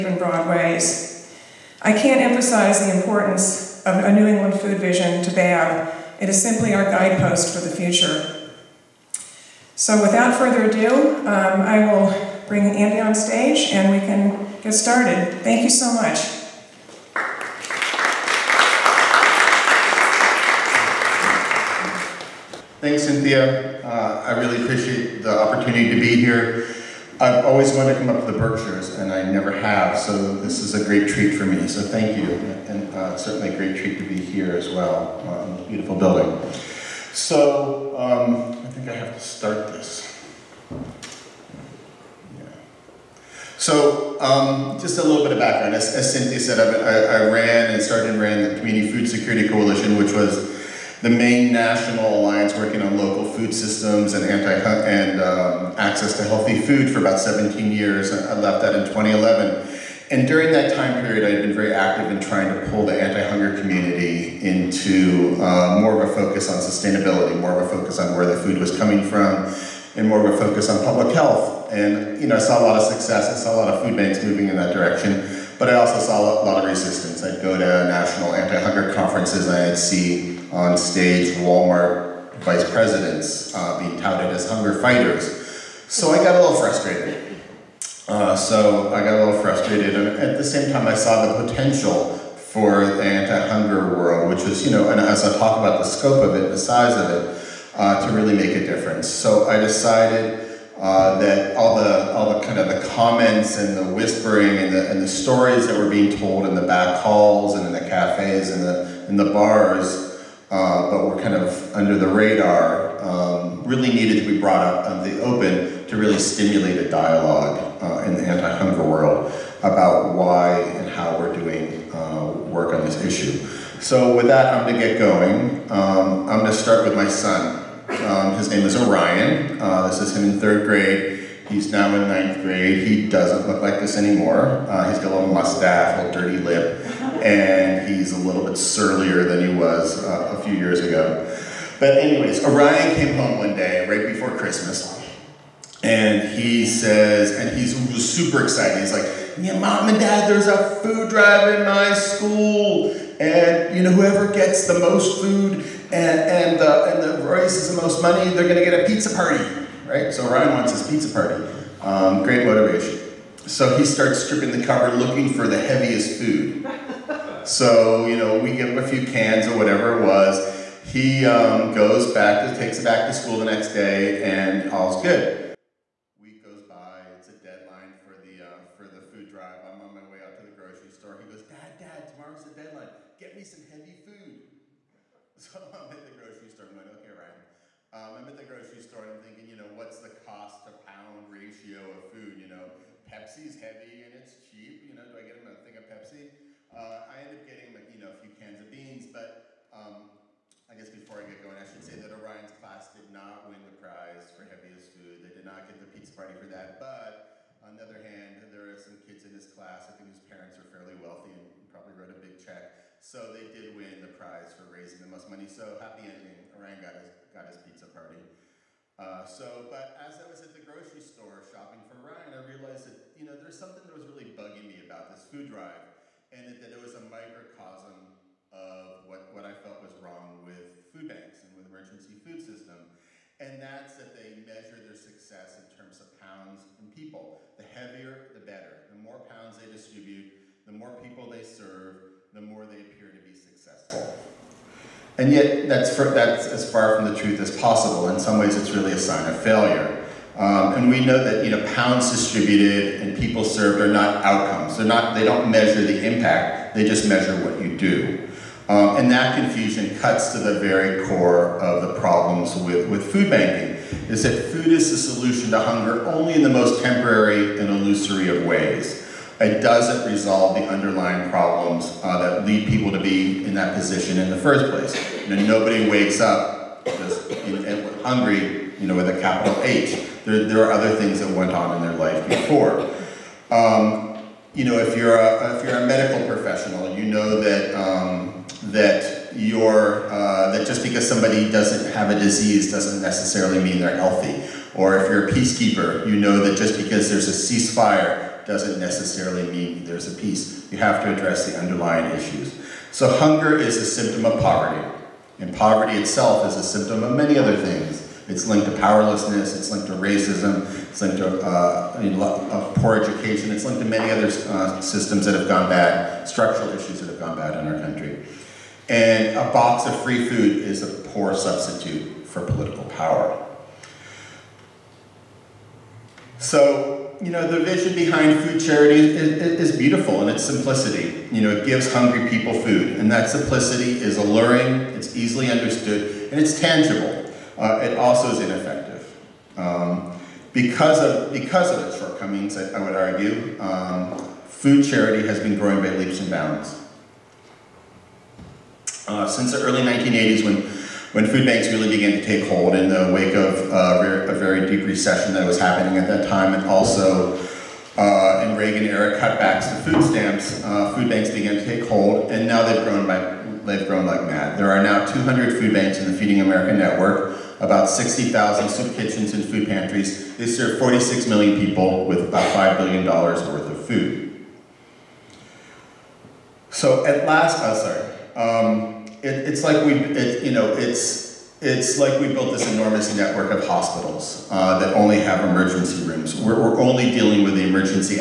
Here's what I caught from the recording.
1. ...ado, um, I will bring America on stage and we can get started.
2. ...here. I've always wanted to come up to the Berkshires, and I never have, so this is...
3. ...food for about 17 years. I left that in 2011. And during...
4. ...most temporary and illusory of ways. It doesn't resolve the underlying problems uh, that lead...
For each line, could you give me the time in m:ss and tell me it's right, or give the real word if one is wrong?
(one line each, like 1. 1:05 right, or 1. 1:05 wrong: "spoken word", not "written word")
1. 0:10 wrong: "Andy", not "America"
2. 0:26 right
3. 0:56 right
4. 4:26 right.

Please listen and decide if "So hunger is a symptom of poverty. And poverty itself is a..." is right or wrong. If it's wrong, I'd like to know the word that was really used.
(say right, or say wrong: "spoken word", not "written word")
right.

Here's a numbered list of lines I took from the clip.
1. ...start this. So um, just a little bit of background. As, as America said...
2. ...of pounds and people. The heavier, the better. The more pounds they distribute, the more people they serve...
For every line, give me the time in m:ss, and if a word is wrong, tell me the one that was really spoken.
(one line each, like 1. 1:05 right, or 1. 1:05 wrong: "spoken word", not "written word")
1. 0:39 wrong: "Cynthia", not "America"
2. 3:56 right.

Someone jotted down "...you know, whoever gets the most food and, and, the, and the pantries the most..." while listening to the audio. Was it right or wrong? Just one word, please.
wrong.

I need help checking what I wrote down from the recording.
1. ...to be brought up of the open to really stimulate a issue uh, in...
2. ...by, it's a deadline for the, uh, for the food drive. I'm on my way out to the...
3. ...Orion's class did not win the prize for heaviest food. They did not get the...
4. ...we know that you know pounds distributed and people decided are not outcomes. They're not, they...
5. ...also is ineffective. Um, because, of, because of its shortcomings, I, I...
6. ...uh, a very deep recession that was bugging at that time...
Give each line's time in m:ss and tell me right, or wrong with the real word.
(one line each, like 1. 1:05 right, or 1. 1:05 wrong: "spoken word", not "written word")
1. 1:54 wrong: "dialogue", not "issue"
2. 2:56 right
3. 3:22 right
4. 4:10 wrong: "served", not "decided"
5. 5:37 right
6. 5:53 wrong: "happening", not "bugging".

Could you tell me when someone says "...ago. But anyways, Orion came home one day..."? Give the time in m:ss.
2:20.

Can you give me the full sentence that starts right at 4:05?
And yet, that's, for, that's as far from the truth as possible.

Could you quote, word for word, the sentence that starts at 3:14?
You know, do I get him a thing of Pepsi?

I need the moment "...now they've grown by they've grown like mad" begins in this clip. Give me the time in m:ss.
6:02.